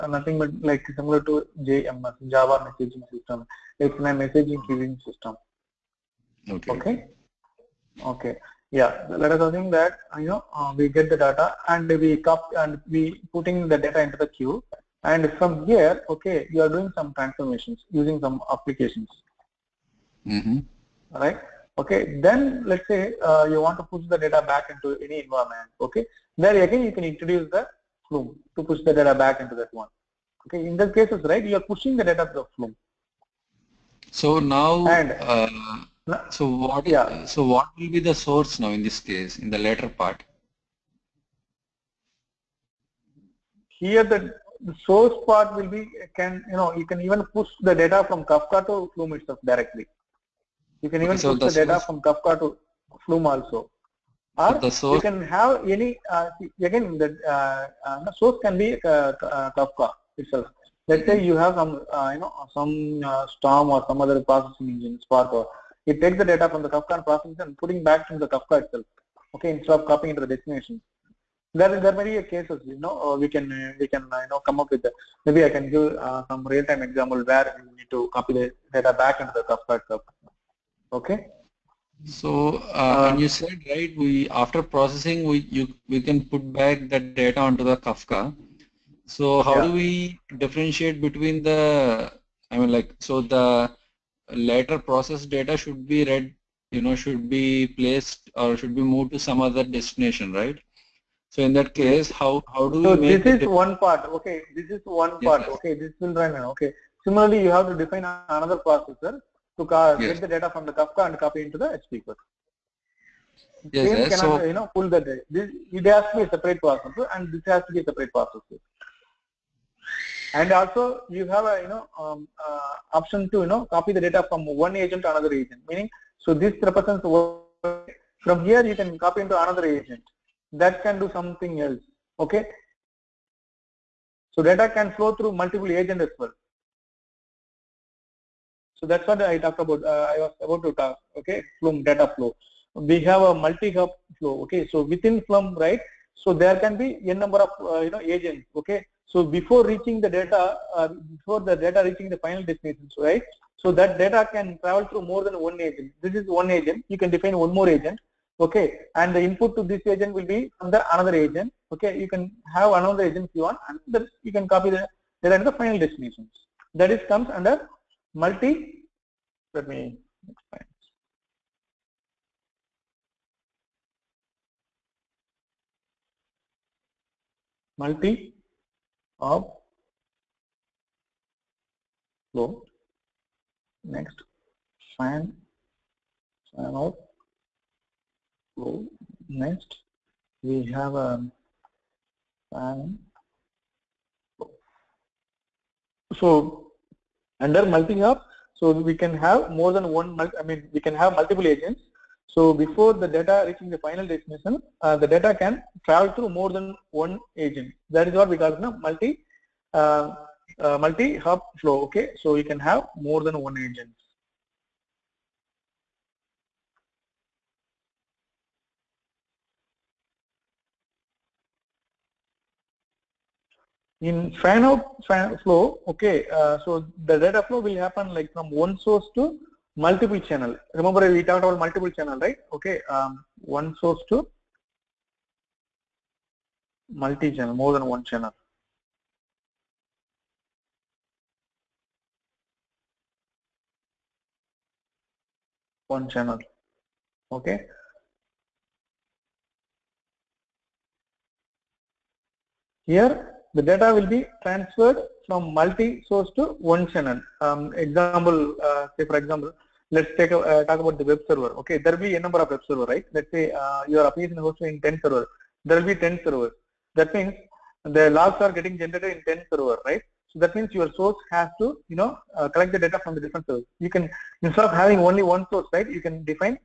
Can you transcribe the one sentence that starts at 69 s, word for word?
Okay, instead of copying into the destination.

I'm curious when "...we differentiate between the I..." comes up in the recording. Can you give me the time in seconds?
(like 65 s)
89 s.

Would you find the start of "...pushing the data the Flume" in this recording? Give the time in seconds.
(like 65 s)
31 s.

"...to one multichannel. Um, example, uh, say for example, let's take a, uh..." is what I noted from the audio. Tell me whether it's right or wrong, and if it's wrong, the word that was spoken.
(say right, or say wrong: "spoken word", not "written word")
wrong: "channel", not "multichannel".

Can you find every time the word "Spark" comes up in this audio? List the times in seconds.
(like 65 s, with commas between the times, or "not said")
65 s.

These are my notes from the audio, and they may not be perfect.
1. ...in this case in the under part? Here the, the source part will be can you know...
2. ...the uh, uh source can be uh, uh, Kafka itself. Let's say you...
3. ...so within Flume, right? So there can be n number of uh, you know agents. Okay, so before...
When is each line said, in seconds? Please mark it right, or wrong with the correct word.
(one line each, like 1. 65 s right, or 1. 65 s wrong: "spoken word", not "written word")
1. 38 s wrong: "later", not "under"
2. 56 s right
3. 144 s right.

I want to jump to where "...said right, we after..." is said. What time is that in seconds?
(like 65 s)
83 s.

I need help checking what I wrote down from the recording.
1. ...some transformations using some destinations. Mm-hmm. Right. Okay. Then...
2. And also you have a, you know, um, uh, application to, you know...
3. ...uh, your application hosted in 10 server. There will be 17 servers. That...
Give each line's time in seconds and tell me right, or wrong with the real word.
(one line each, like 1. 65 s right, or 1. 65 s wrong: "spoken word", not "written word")
1. 16 s wrong: "applications", not "destinations"
2. 120 s wrong: "option", not "application"
3. 263 s wrong: "10", not "17".